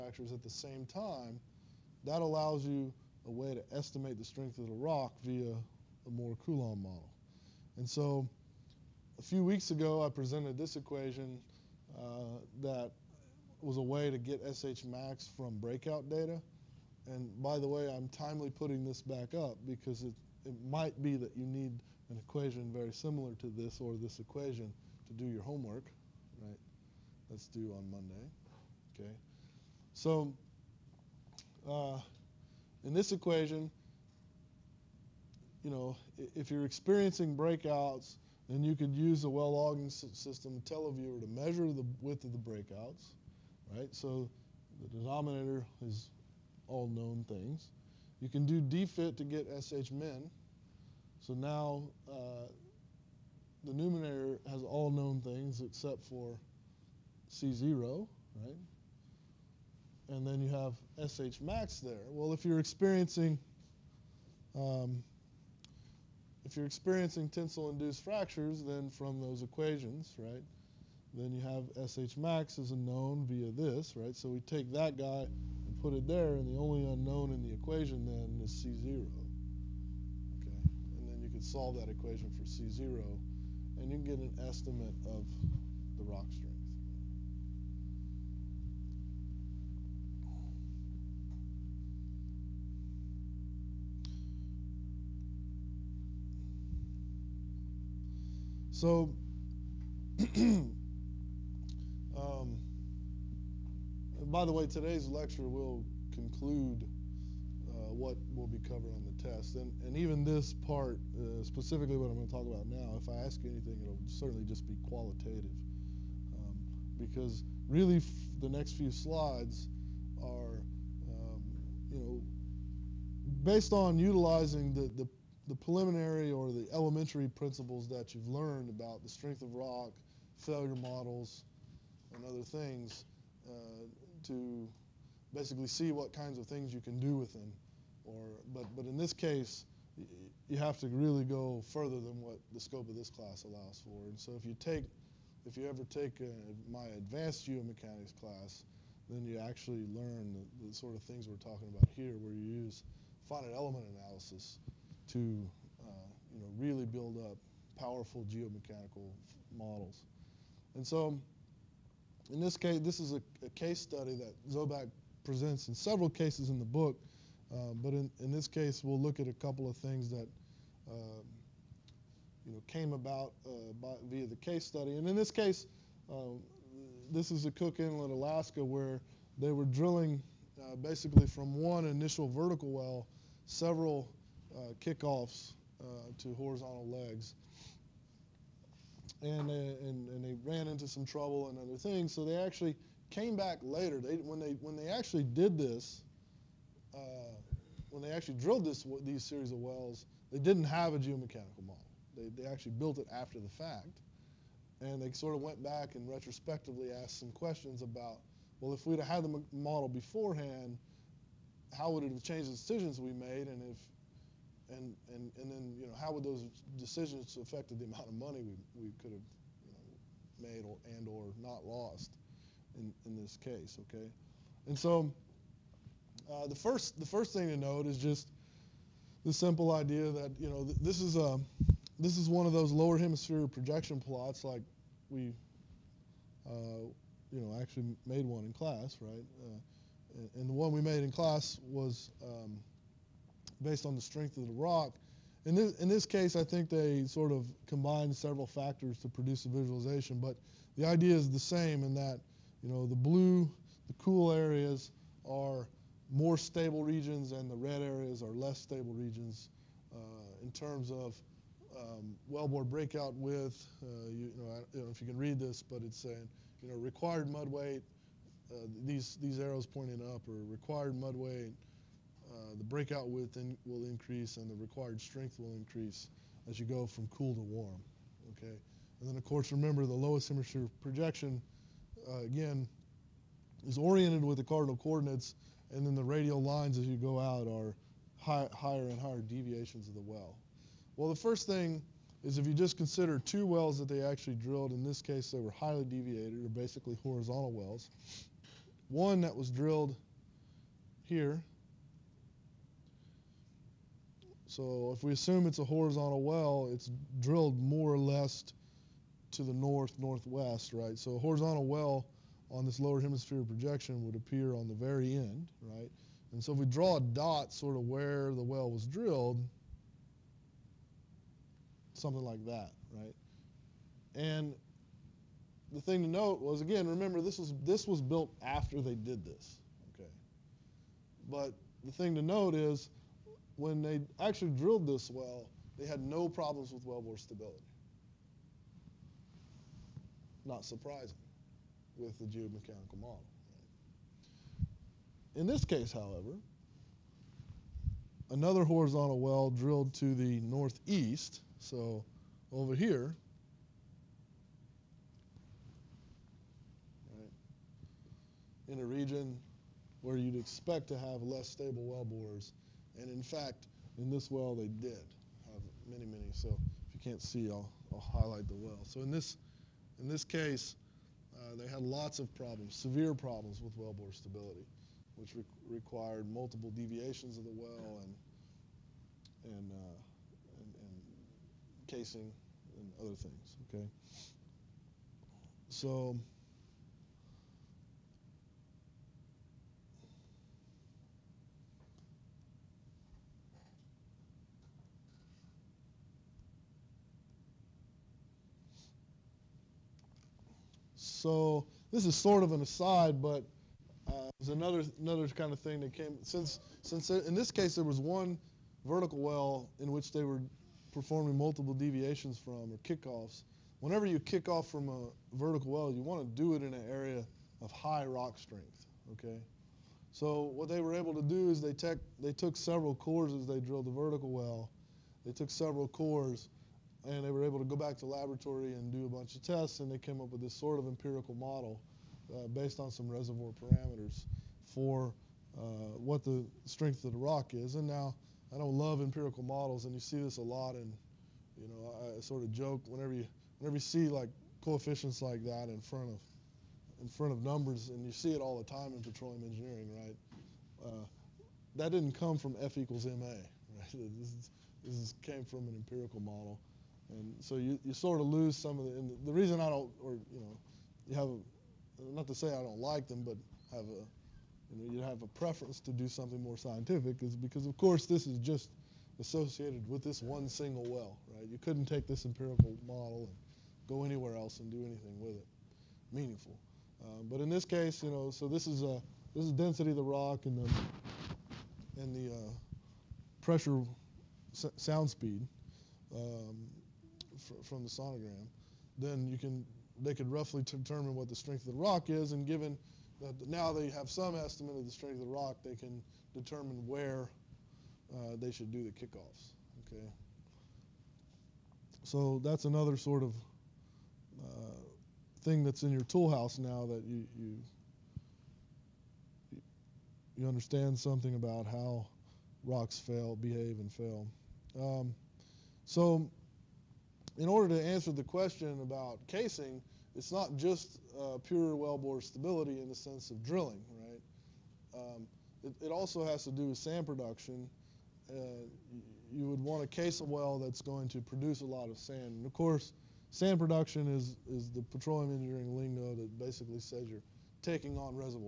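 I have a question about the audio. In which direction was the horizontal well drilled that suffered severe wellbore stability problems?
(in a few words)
northeast.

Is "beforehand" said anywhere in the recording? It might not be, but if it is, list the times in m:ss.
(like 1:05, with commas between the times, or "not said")
3:29.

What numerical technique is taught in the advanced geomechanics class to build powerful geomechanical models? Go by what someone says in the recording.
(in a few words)
finite element analysis.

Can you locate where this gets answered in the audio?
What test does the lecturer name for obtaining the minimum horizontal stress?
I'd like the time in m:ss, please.
0:48.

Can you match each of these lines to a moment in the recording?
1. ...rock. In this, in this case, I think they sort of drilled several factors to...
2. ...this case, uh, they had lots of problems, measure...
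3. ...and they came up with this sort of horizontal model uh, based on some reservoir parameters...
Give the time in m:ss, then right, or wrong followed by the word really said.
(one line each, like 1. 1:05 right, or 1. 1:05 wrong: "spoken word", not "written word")
1. 4:04 wrong: "combined", not "drilled"
2. 6:10 wrong: "severe", not "measure"
3. 7:09 wrong: "empirical", not "horizontal".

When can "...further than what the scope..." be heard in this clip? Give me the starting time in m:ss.
2:21.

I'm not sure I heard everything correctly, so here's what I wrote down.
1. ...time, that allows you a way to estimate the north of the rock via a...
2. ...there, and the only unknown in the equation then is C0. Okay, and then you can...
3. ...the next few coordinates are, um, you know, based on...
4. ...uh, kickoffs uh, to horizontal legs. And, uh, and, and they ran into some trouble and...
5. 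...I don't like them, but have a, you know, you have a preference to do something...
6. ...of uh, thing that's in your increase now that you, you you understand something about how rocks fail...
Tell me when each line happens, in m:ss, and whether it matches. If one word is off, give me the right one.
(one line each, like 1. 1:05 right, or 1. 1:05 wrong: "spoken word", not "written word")
1. 0:00 wrong: "strength", not "north"
2. 1:16 right
3. 1:58 wrong: "slides", not "coordinates"
4. 3:04 right
5. 7:42 right
6. 8:23 wrong: "toolhouse", not "increase".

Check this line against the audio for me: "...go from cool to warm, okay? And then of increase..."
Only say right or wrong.
wrong.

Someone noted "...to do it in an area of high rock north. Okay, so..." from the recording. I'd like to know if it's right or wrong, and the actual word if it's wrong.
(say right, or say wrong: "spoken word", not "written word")
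wrong: "strength", not "north".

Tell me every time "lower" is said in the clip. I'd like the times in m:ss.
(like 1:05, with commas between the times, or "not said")
3:52, 4:39, 5:12.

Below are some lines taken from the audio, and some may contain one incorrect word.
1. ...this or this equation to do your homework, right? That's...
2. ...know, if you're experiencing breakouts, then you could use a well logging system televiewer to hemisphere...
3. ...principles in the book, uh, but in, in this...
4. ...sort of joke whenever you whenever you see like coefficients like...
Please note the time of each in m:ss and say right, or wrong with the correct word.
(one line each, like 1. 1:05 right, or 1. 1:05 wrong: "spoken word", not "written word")
1. 0:23 right
2. 0:35 wrong: "measure", not "hemisphere"
3. 2:46 wrong: "cases", not "principles"
4. 7:22 right.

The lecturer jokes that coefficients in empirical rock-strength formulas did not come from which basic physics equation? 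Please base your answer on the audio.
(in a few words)
F equals ma.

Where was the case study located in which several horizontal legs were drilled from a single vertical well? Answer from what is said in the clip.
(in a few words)
Cook Inlet, Alaska.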